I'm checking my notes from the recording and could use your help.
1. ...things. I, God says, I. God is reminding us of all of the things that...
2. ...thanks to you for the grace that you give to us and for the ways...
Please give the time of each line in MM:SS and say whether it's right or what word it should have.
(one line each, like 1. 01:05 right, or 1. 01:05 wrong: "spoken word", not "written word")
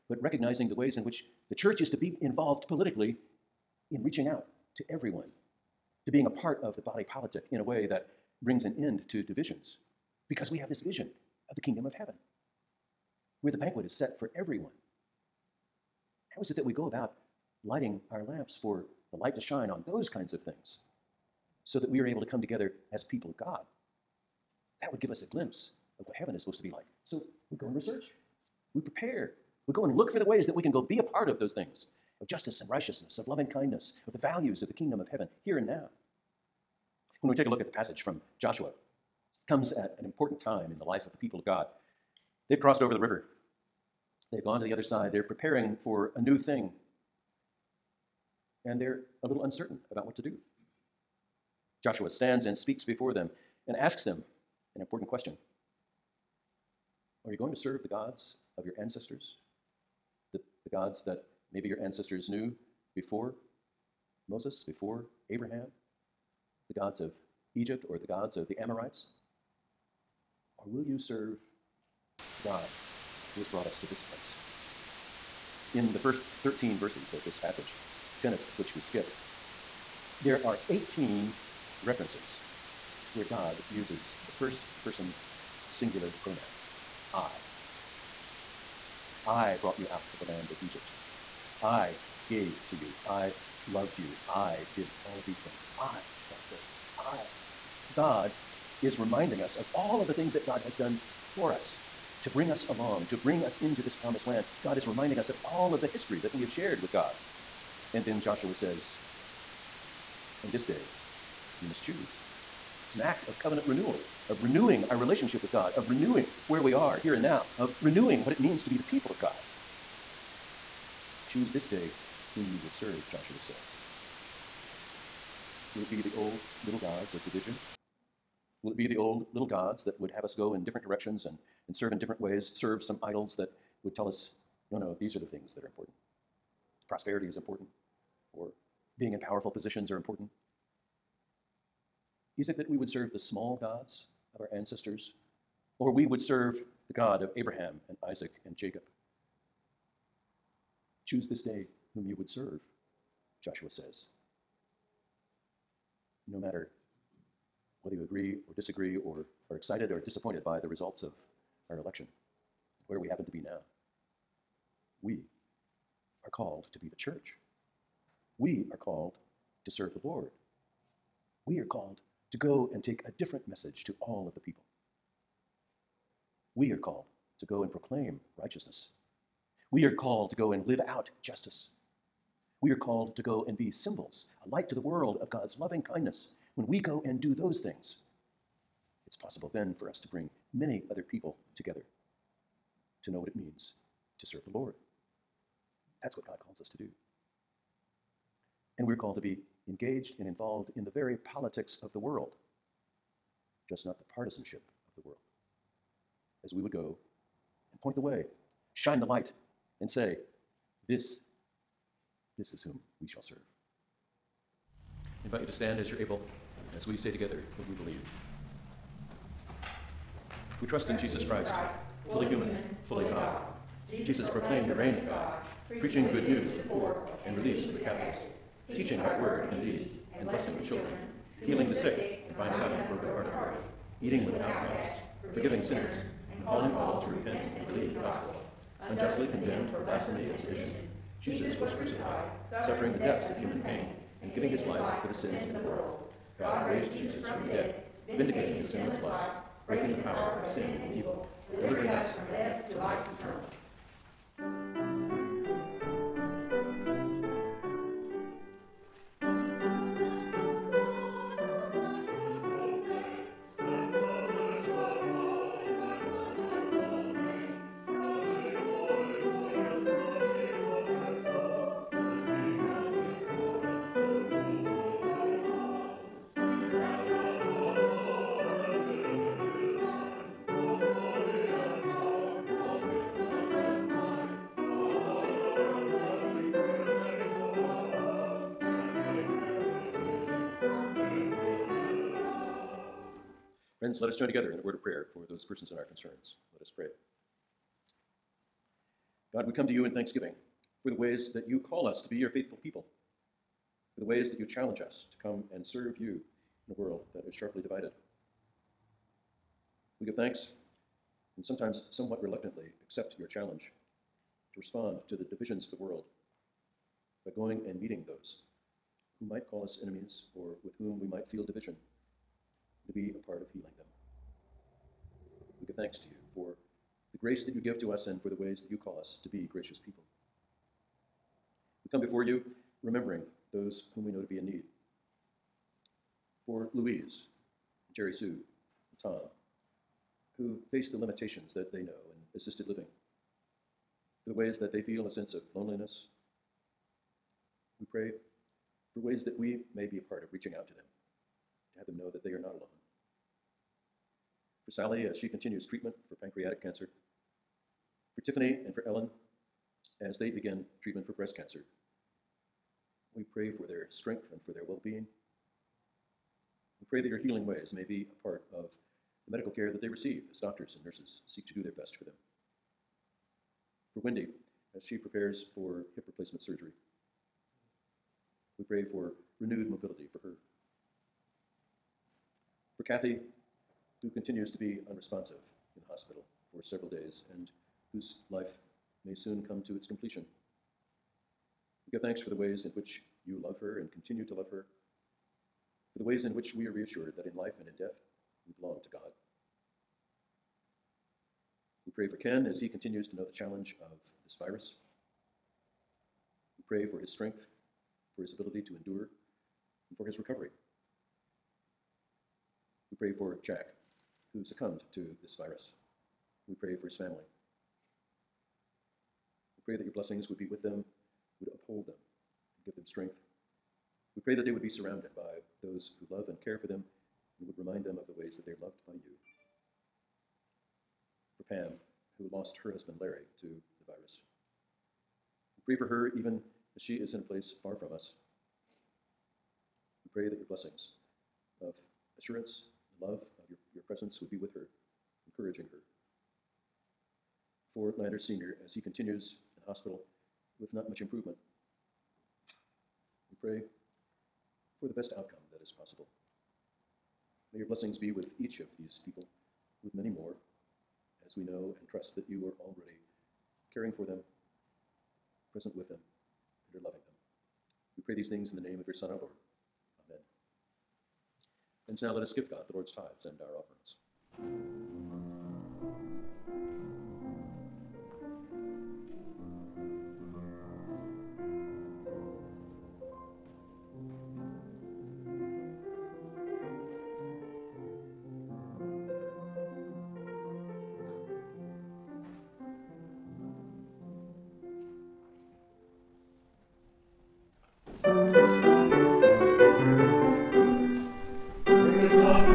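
1. 01:35 right
2. 05:25 right.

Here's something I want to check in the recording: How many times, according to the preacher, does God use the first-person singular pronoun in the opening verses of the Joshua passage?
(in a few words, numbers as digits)
18.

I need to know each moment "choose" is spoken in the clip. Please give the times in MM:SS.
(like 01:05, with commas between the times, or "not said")
01:51, 02:01, 02:31.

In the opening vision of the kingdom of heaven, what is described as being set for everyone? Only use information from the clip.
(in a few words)
banquet.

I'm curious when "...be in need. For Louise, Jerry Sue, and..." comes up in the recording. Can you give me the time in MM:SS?
05:34.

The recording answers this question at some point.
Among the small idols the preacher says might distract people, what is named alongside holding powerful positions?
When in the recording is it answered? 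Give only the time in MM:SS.
02:16.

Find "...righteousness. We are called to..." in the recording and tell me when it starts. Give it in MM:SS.
02:58.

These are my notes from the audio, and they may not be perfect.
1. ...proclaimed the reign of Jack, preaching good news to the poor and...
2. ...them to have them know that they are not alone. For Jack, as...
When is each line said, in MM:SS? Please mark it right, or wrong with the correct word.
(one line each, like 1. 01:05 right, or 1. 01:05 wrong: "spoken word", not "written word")
1. 03:44 wrong: "God", not "Jack"
2. 05:50 wrong: "Sally", not "Jack".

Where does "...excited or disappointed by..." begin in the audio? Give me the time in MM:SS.
02:39.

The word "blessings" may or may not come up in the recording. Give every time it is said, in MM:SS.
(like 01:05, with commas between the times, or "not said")
03:50, 06:59, 07:20, 07:37.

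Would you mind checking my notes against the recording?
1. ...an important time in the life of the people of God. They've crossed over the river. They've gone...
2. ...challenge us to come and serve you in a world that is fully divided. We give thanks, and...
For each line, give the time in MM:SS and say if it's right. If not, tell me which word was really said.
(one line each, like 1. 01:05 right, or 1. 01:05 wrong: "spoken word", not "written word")
1. 00:39 right
2. 05:04 wrong: "sharply", not "fully".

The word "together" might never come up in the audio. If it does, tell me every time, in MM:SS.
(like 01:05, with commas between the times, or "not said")
00:22, 03:11, 03:37, 04:54.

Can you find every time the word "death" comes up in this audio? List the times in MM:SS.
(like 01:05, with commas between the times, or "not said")
04:12, 06:37.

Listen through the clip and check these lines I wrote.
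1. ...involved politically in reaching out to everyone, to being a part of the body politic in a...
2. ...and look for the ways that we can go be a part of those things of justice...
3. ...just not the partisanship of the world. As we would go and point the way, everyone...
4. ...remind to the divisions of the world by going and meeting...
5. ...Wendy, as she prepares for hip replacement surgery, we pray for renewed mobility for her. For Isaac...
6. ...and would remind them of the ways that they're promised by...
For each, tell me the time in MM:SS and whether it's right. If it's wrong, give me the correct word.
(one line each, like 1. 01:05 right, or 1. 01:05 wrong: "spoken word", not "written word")
1. 00:02 right
2. 00:29 right
3. 03:23 wrong: "shine", not "everyone"
4. 05:14 wrong: "respond", not "remind"
5. 06:14 wrong: "Kathy", not "Isaac"
6. 07:07 wrong: "loved", not "promised".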